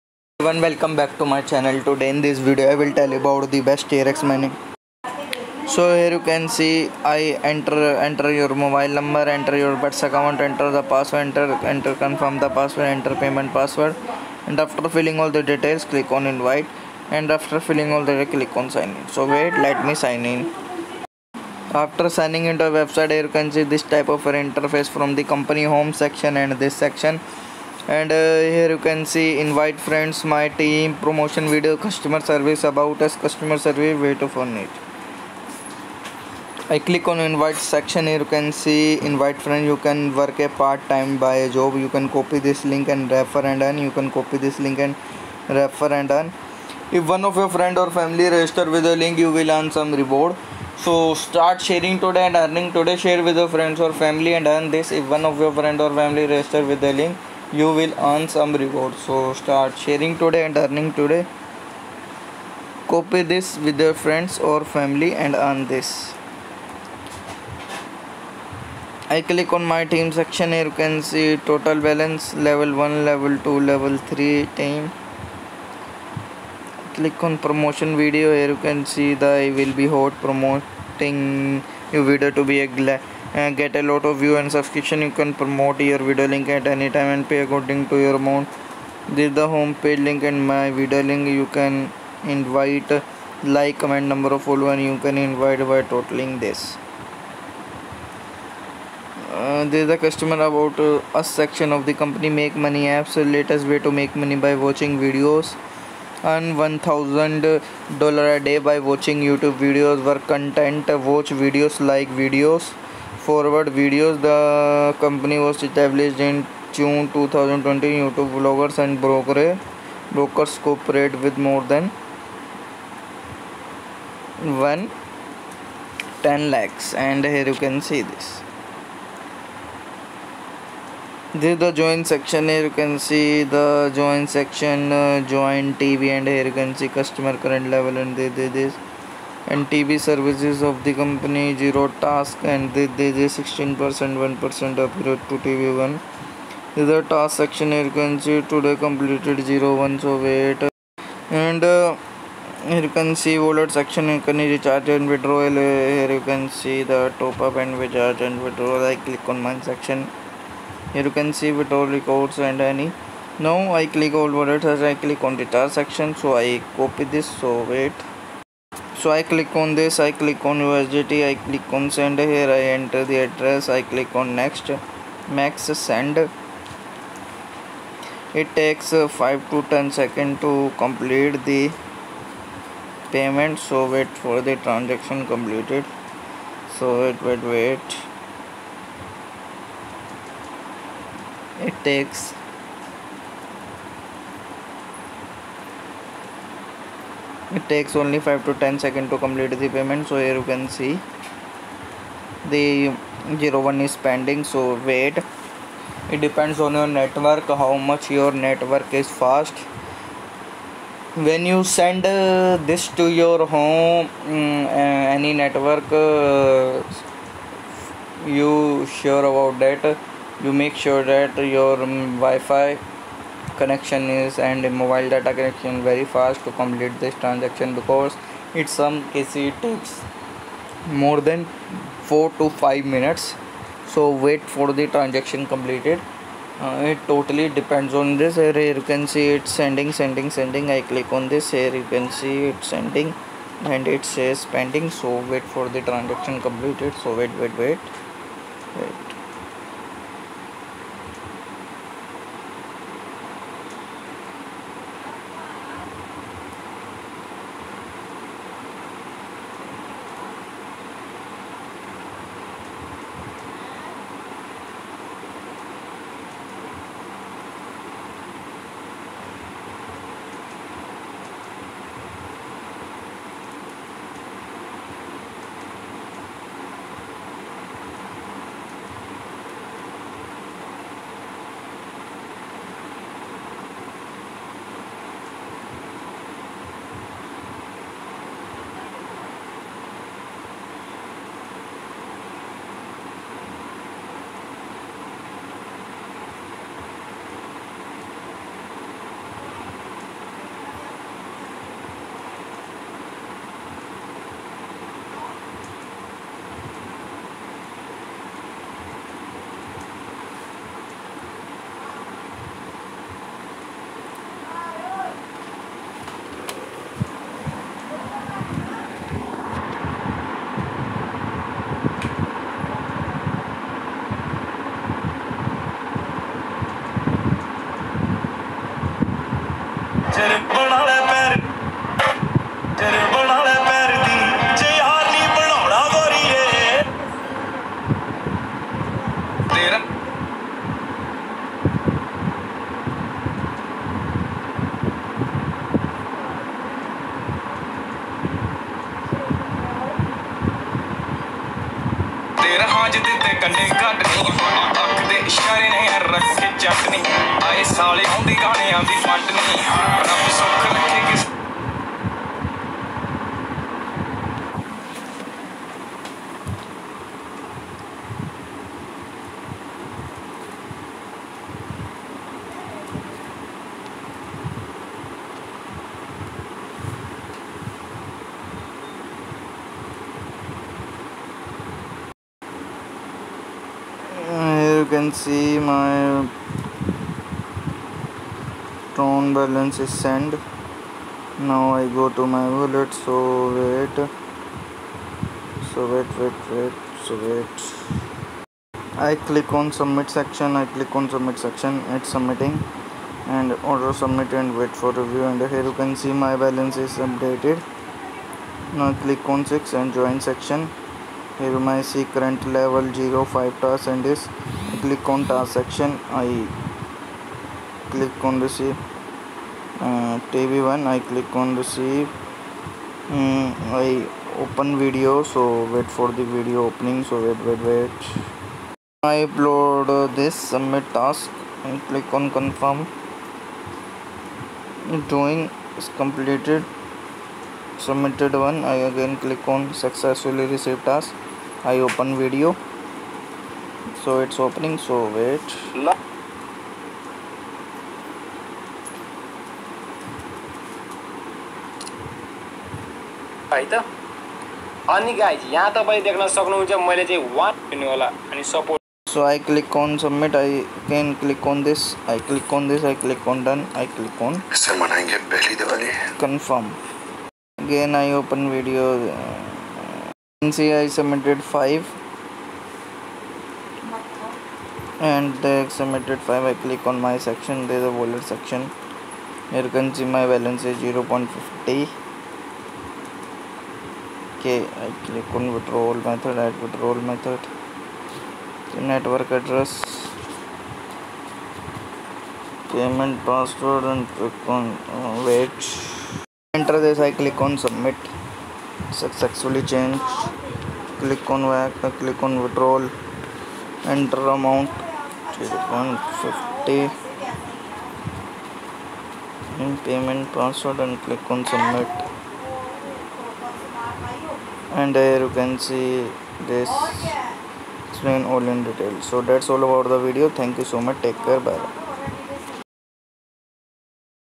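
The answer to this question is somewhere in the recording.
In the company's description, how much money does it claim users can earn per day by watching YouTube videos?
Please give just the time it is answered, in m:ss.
1:46.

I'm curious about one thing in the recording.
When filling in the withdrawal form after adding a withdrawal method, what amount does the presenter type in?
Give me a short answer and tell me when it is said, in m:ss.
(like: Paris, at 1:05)
150, at 8:25.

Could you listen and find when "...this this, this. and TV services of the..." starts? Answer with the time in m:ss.
2:18.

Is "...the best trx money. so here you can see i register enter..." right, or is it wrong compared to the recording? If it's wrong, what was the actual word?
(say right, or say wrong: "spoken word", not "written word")
wrong: "enter", not "register".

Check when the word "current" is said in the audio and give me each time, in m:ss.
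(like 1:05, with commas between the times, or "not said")
2:17, 6:52.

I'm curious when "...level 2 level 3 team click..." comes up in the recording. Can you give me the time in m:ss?
1:13.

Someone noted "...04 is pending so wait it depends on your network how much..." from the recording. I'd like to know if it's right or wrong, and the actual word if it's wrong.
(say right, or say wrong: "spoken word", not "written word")
wrong: "01", not "04".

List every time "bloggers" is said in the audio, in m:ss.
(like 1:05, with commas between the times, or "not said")
1:58.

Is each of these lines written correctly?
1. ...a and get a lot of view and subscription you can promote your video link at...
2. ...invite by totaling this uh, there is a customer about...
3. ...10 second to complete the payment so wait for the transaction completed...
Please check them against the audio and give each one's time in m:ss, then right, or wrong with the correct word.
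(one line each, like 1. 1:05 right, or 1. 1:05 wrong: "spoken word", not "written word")
1. 1:22 right
2. 1:35 right
3. 2:59 right.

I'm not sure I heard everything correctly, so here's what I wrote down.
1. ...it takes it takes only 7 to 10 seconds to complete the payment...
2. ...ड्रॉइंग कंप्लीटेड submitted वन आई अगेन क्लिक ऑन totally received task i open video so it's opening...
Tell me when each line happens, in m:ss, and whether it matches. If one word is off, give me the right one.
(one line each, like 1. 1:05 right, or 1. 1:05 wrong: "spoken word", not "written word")
1. 3:11 wrong: "5", not "7"
2. 7:15 wrong: "successfully", not "totally".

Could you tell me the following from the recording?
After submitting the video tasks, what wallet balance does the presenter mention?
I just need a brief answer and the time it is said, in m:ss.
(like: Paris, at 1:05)
0.50, at 8:00.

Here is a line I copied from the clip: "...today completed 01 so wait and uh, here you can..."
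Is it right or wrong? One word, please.
right.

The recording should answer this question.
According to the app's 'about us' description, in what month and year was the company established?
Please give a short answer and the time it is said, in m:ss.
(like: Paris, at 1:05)
June 2020, at 1:56.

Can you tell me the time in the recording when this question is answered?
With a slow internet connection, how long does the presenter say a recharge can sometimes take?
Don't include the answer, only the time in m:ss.
3:52.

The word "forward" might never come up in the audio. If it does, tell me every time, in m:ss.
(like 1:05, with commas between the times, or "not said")
1:53.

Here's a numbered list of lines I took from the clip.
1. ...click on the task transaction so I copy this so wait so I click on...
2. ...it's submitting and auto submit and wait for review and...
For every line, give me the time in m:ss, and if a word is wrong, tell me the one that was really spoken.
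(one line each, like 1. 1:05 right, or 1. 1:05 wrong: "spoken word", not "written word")
1. 2:44 wrong: "section", not "transaction"
2. 6:41 right.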